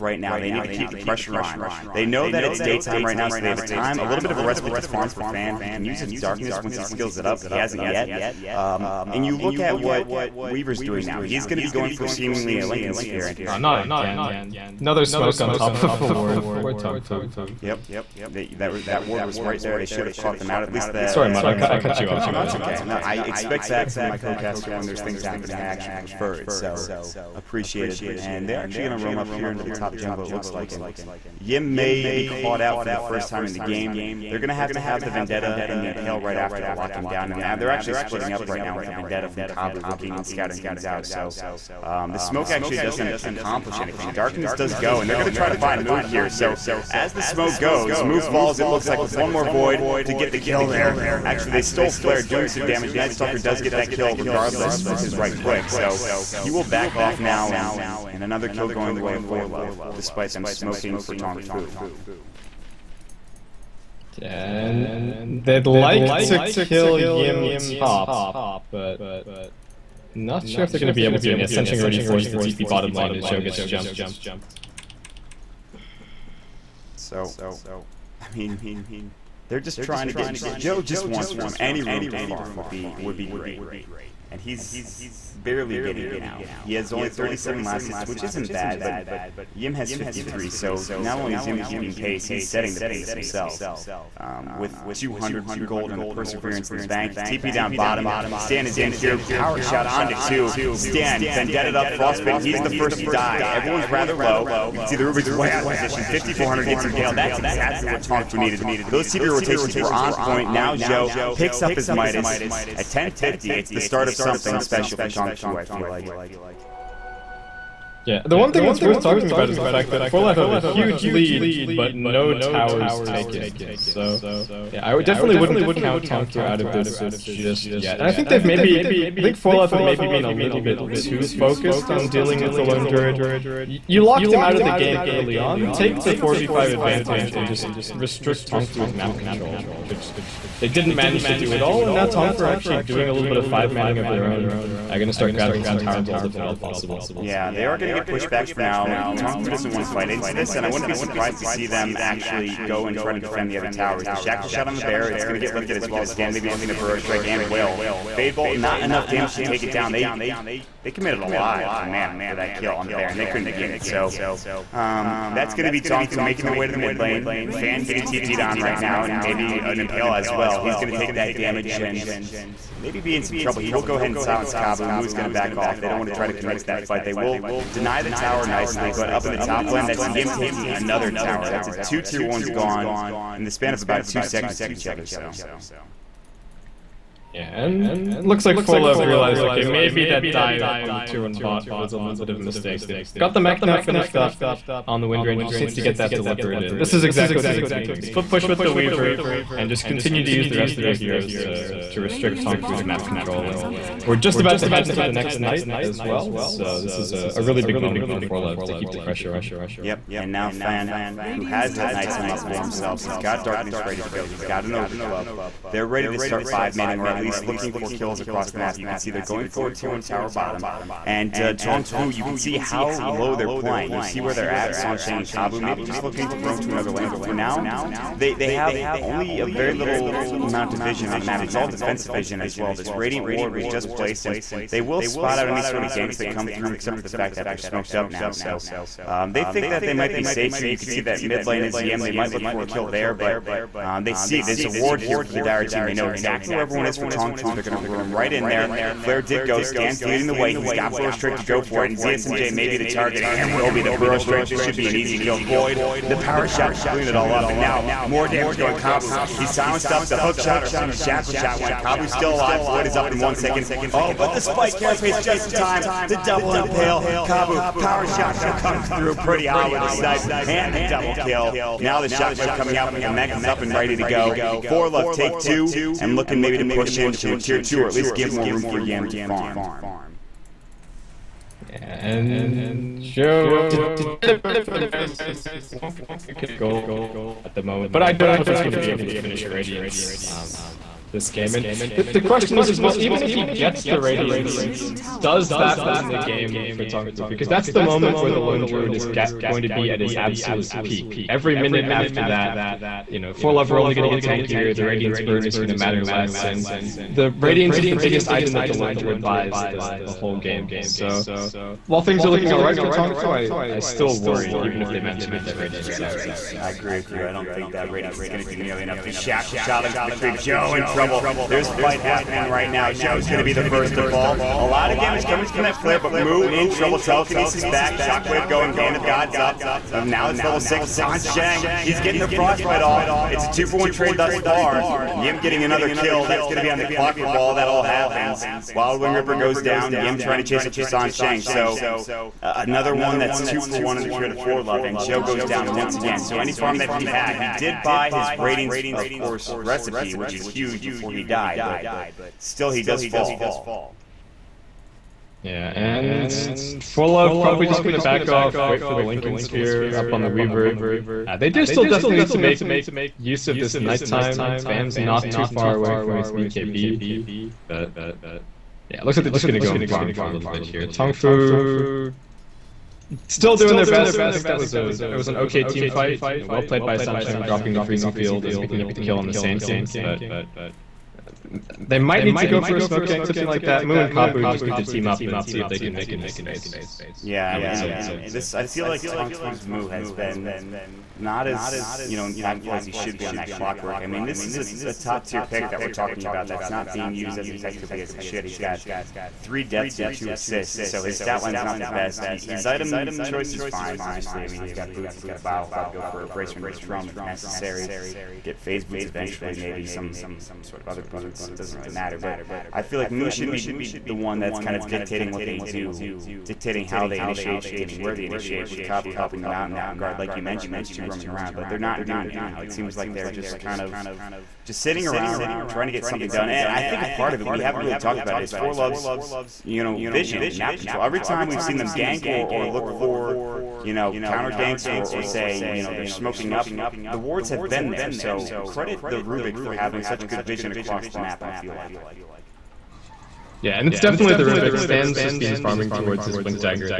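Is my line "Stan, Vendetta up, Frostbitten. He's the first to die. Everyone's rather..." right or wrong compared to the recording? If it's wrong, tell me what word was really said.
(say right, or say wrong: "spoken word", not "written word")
right.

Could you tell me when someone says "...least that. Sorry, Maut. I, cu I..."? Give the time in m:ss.
0:20.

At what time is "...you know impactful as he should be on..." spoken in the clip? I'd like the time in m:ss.
6:32.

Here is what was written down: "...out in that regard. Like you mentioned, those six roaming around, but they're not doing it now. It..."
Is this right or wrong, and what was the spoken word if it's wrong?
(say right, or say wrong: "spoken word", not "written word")
wrong: "two", not "six".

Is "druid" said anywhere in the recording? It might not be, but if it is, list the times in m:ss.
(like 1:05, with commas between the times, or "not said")
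2:12, 4:58, 5:08.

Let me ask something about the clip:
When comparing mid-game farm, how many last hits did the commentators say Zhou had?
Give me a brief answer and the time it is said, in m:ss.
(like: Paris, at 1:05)
37, at 1:27.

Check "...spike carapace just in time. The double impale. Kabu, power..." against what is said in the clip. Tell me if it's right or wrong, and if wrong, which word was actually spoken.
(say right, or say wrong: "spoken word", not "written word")
right.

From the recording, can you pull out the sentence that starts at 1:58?
Yeah, the one thing that's worth talking about is the fact that 4 Life have a huge lead, but no towers taken.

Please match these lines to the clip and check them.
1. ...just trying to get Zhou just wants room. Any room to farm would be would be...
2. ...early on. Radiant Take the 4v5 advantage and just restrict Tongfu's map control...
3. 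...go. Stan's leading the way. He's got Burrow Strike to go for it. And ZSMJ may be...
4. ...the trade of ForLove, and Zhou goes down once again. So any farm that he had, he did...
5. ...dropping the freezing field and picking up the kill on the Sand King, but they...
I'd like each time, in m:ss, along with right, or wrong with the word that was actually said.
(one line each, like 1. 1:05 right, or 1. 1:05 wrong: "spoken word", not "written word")
1. 1:19 right
2. 2:15 right
3. 4:09 right
4. 5:44 right
5. 6:17 right.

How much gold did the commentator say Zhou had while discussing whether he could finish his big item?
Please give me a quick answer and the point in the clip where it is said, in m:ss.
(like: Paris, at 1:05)
1.2k, at 4:44.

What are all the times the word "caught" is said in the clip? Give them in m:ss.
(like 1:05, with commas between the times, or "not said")
0:20, 0:32.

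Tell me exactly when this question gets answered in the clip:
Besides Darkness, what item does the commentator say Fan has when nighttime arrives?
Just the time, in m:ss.
3:34.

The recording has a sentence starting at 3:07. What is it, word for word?
Yeah, and looks like ForLove realized, okay, maybe that dive on the tier 1 bot was a little bit of a mistake.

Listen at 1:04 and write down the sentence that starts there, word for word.
And they'd like to kill Yim top, but not sure if they're going to be able to.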